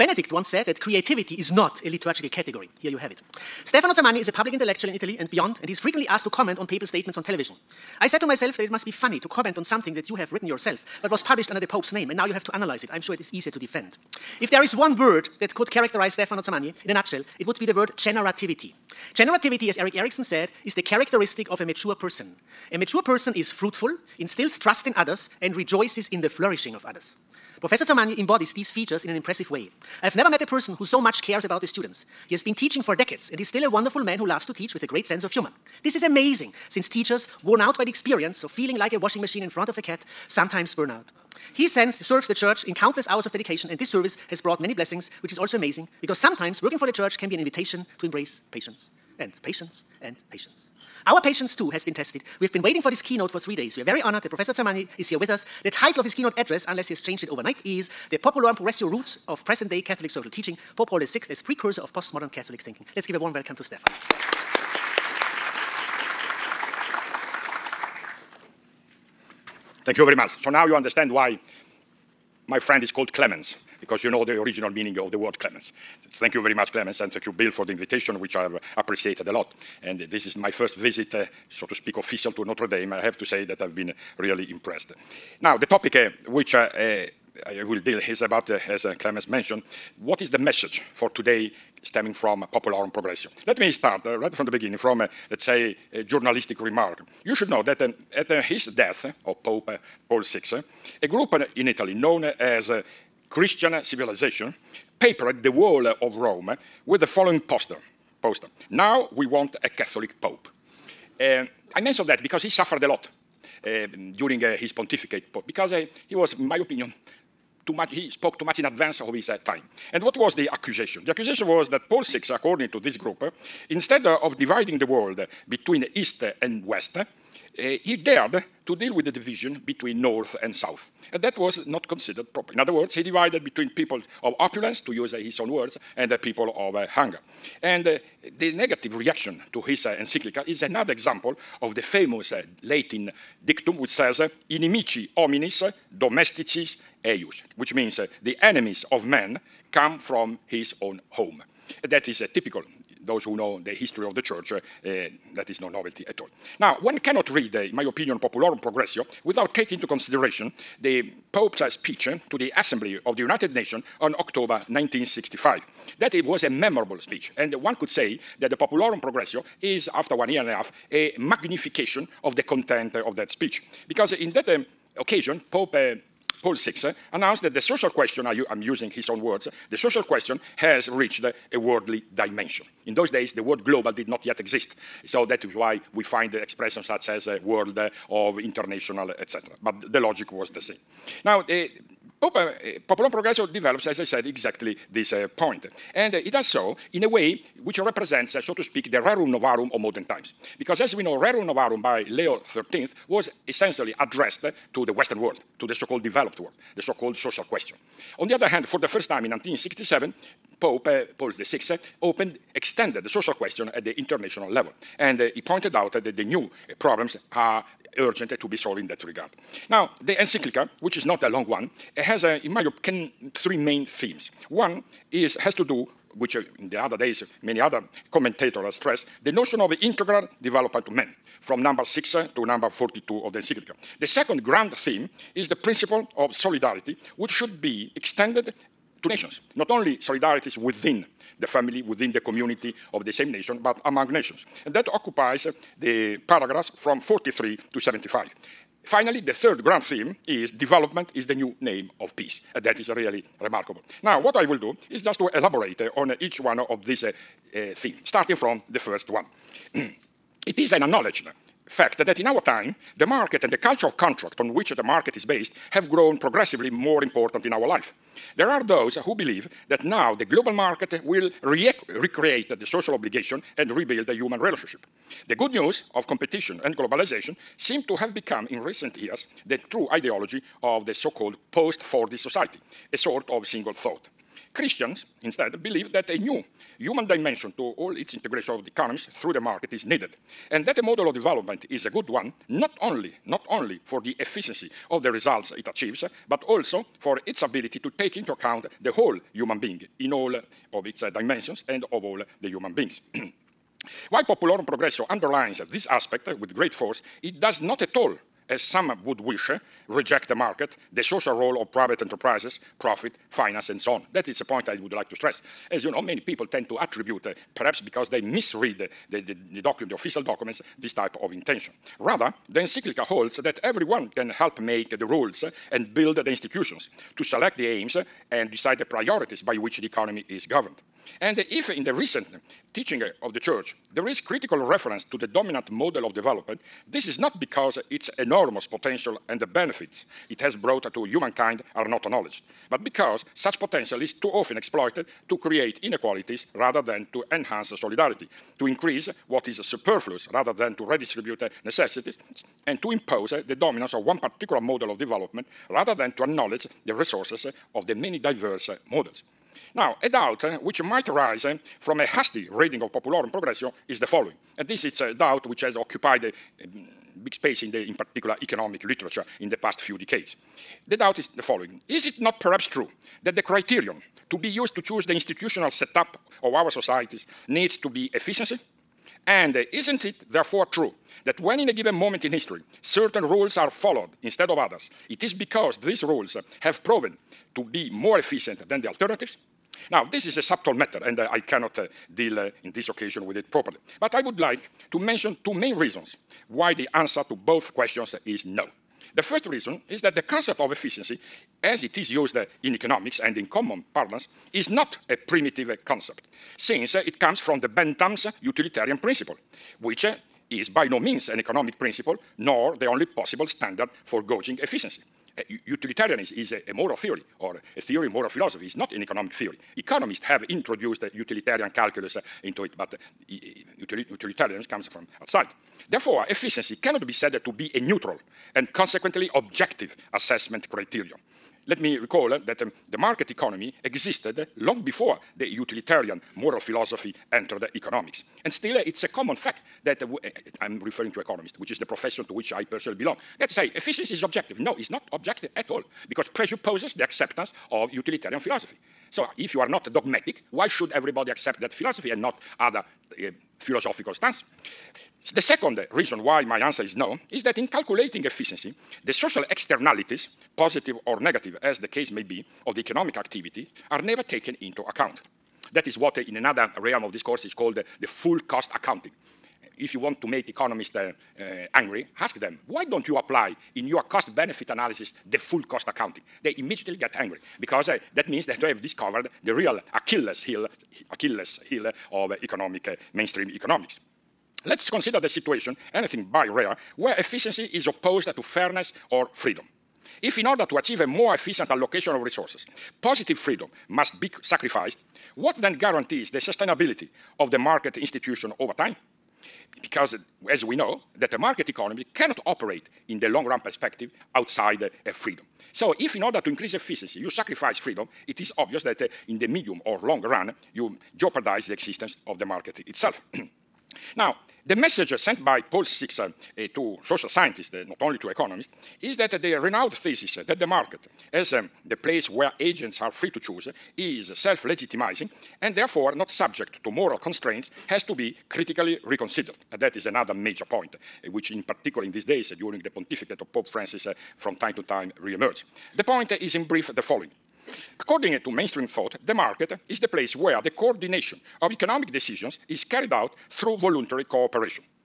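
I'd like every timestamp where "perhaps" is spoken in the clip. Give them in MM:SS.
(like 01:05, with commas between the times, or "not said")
05:17, 06:12.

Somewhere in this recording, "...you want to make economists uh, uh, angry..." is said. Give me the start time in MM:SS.
07:49.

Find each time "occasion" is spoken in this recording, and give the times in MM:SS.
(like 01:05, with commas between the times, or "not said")
02:54, 06:32.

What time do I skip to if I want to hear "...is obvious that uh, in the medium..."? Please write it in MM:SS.
08:28.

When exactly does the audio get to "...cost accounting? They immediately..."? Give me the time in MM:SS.
07:55.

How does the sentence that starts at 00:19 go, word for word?
Generativity, as Erik Erikson said, is the characteristic of a mature person.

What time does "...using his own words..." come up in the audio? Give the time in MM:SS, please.
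02:58.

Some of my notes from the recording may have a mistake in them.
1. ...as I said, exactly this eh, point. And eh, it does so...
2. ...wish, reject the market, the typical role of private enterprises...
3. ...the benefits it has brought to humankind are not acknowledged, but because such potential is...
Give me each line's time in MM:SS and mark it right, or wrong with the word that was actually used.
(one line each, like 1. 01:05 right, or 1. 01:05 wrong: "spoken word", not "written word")
1. 03:13 right
2. 05:09 wrong: "social", not "typical"
3. 05:39 right.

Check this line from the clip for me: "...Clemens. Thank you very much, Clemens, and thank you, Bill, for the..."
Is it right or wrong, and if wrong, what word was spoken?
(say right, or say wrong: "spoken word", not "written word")
right.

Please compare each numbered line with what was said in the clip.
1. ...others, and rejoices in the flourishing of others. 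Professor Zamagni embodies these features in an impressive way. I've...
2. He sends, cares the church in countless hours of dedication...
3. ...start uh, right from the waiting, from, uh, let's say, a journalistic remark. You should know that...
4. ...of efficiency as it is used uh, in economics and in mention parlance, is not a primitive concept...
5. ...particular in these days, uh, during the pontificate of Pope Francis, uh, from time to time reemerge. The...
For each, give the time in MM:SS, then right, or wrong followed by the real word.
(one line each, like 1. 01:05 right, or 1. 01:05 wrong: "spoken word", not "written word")
1. 00:24 right
2. 00:41 wrong: "serves", not "cares"
3. 01:33 wrong: "beginning", not "waiting"
4. 06:40 wrong: "common", not "mention"
5. 08:51 right.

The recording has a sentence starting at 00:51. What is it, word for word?
Our patience too has been tested.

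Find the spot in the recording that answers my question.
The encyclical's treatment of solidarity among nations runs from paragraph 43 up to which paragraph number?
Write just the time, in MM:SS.
04:07.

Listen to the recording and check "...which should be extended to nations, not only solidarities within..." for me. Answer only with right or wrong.
right.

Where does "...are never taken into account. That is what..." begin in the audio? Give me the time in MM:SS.
07:43.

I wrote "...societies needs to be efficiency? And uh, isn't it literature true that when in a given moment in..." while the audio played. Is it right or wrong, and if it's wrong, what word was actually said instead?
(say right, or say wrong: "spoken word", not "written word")
wrong: "therefore", not "literature".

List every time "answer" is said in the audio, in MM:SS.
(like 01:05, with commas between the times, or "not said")
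06:36, 07:36.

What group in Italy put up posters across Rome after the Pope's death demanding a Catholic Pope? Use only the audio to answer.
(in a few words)
Christian Civilization.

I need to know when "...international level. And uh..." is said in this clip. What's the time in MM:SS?
03:33.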